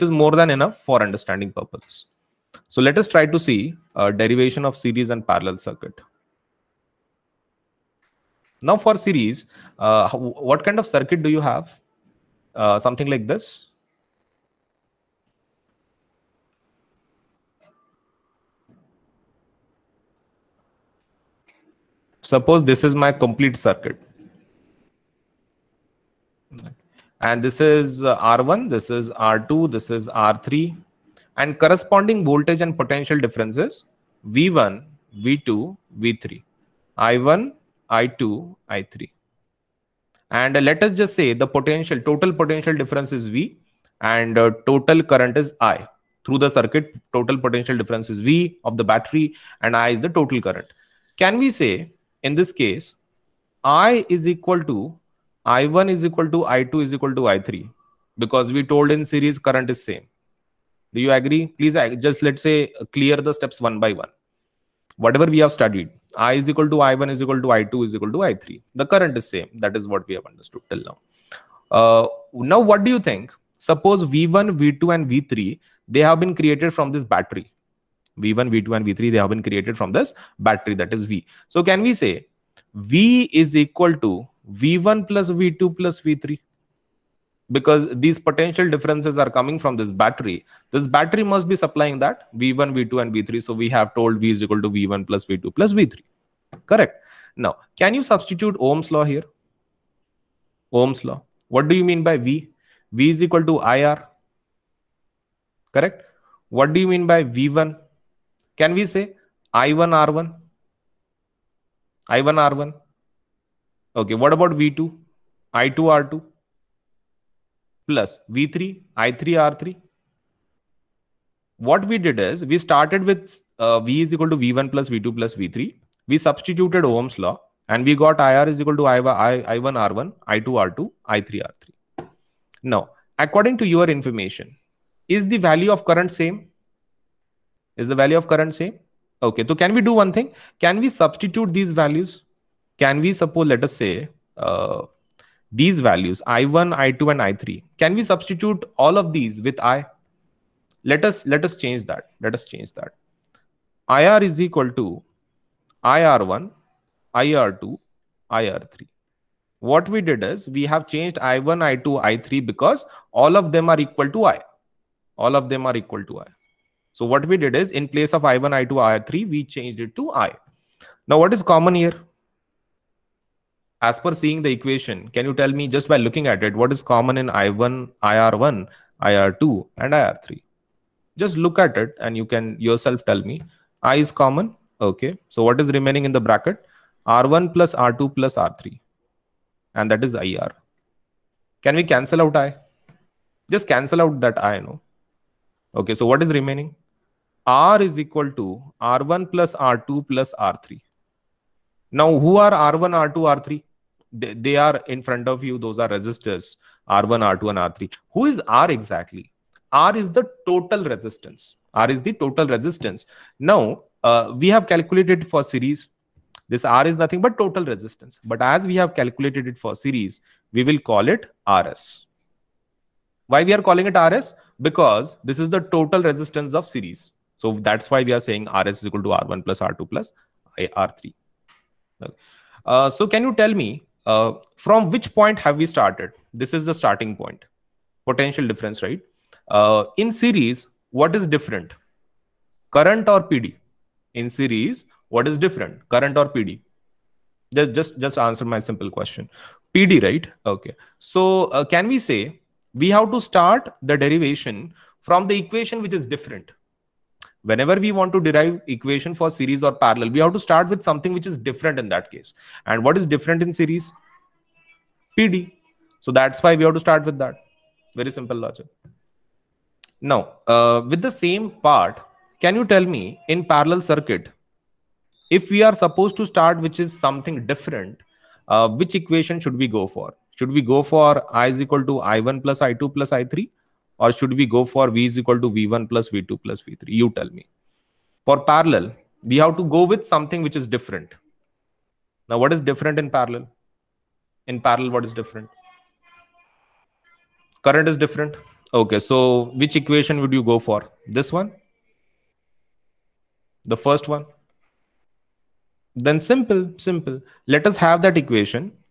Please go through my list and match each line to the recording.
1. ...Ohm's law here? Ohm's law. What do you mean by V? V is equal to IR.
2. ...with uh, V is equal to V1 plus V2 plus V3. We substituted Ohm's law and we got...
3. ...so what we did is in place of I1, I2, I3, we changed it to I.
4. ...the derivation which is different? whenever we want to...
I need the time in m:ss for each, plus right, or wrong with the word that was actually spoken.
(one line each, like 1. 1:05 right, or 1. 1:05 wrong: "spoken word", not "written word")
1. 1:38 right
2. 2:03 right
3. 2:46 right
4. 4:15 wrong: "equation", not "derivation".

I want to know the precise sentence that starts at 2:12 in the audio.
Now, according to your information, is the value of current same?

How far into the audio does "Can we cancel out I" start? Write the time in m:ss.
3:11.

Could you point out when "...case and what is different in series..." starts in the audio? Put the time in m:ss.
4:22.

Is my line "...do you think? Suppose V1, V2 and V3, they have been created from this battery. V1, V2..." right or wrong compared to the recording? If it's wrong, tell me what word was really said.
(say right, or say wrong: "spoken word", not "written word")
right.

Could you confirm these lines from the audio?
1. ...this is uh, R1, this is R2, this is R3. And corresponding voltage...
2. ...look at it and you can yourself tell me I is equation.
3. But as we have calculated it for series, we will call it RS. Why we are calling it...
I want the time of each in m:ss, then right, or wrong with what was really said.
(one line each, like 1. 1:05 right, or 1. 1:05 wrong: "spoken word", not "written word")
1. 0:27 right
2. 3:01 wrong: "common", not "equation"
3. 3:38 right.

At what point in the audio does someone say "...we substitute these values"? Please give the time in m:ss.
2:20.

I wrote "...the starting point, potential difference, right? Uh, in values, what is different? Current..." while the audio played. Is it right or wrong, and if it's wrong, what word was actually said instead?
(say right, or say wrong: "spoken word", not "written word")
wrong: "series", not "values".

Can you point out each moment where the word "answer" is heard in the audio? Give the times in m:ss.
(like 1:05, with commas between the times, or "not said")
4:08.